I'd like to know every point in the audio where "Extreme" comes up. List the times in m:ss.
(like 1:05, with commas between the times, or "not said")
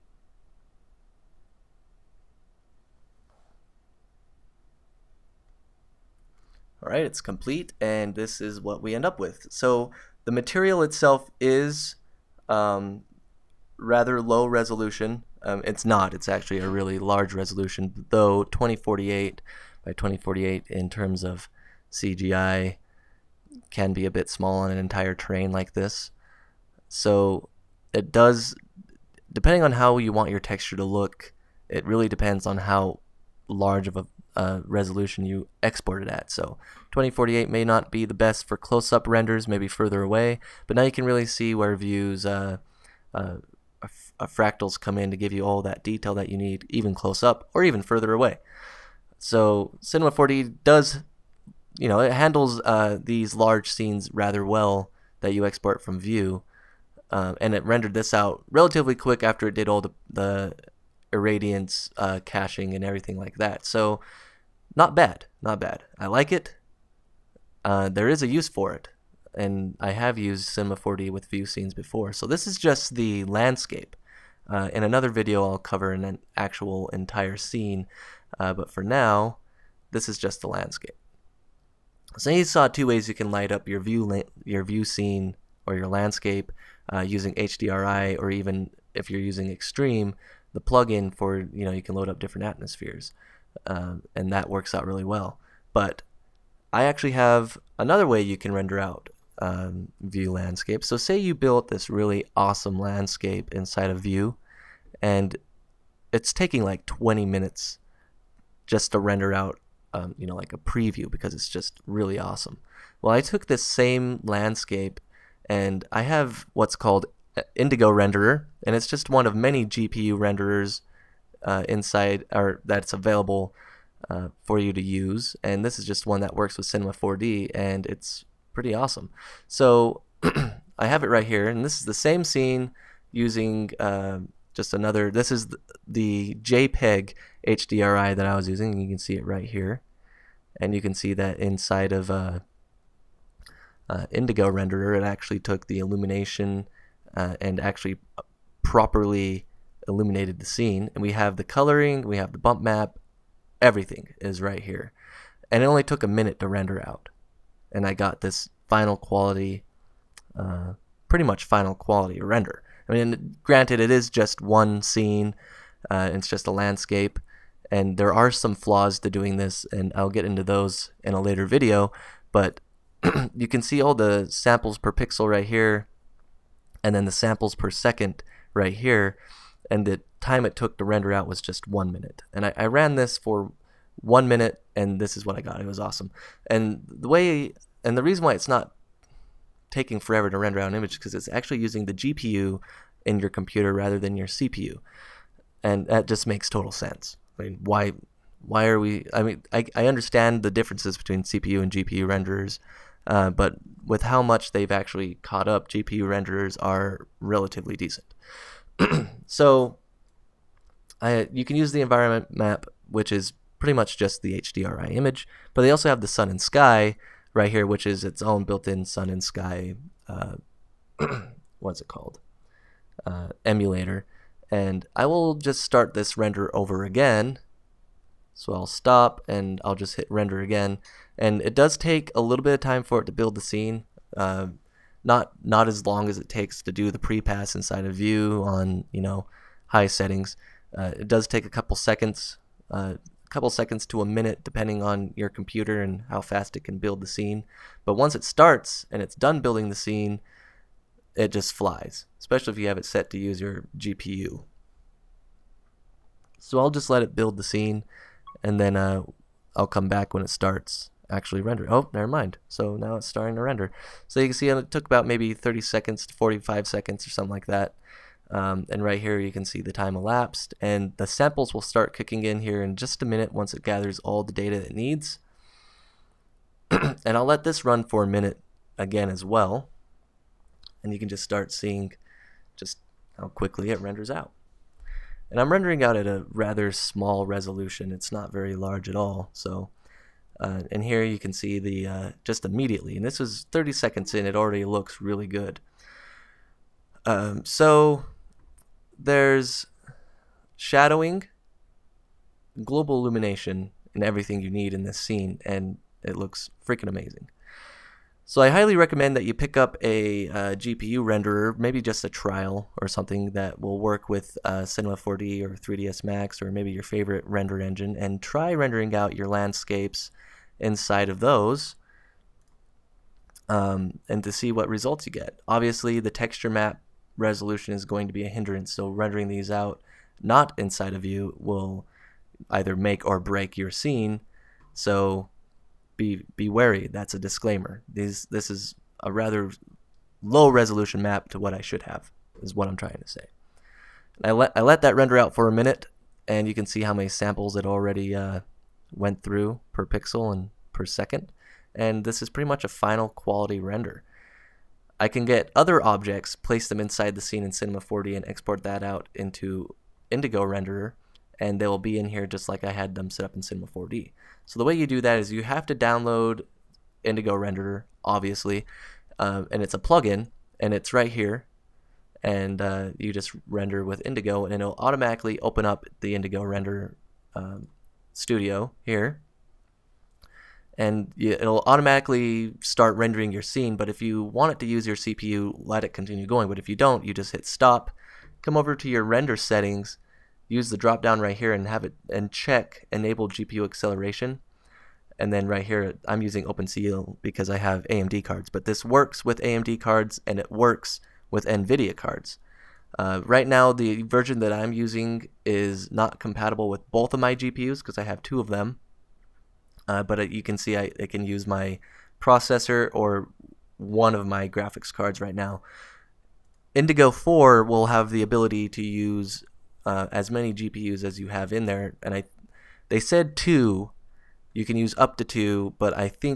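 1:29.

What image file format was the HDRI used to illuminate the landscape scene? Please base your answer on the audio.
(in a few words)
JPEG.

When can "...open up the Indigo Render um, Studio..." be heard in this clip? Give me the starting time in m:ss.
6:15.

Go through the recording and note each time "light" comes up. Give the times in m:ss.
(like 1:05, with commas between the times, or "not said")
1:23.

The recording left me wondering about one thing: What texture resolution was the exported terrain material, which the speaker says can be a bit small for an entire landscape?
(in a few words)
2048 by 2048.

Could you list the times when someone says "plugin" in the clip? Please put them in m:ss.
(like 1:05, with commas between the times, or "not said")
1:30, 6:09.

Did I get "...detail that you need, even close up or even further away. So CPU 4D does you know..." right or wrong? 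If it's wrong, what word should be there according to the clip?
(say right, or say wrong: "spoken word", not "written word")
wrong: "Cinema", not "CPU".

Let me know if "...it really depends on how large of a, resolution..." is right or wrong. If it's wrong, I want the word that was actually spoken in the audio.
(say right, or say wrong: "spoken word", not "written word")
right.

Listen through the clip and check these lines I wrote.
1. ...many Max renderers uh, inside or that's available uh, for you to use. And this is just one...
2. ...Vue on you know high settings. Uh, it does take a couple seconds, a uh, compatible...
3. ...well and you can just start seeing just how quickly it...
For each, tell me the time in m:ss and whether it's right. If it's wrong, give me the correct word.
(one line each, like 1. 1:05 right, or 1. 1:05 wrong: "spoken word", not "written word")
1. 1:59 wrong: "GPU", not "Max"
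2. 3:57 wrong: "couple", not "compatible"
3. 4:39 right.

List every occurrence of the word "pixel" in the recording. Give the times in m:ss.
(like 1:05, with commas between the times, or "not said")
2:54, 5:49.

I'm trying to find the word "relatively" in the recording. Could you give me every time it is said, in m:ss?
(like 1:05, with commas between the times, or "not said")
0:58, 3:27.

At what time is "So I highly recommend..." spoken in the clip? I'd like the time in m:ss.
5:08.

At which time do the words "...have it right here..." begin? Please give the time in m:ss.
2:10.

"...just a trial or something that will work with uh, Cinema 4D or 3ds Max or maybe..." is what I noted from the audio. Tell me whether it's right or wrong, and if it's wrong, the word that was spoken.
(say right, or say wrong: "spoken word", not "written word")
right.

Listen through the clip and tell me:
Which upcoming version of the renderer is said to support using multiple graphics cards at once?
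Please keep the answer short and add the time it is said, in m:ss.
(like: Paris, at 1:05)
Indigo 4, at 6:56.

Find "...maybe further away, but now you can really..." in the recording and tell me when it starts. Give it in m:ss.
0:39.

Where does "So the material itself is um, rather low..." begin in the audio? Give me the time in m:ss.
0:09.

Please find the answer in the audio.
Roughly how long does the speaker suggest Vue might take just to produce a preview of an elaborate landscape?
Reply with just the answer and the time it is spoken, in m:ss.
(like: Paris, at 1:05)
20 minutes, at 1:46.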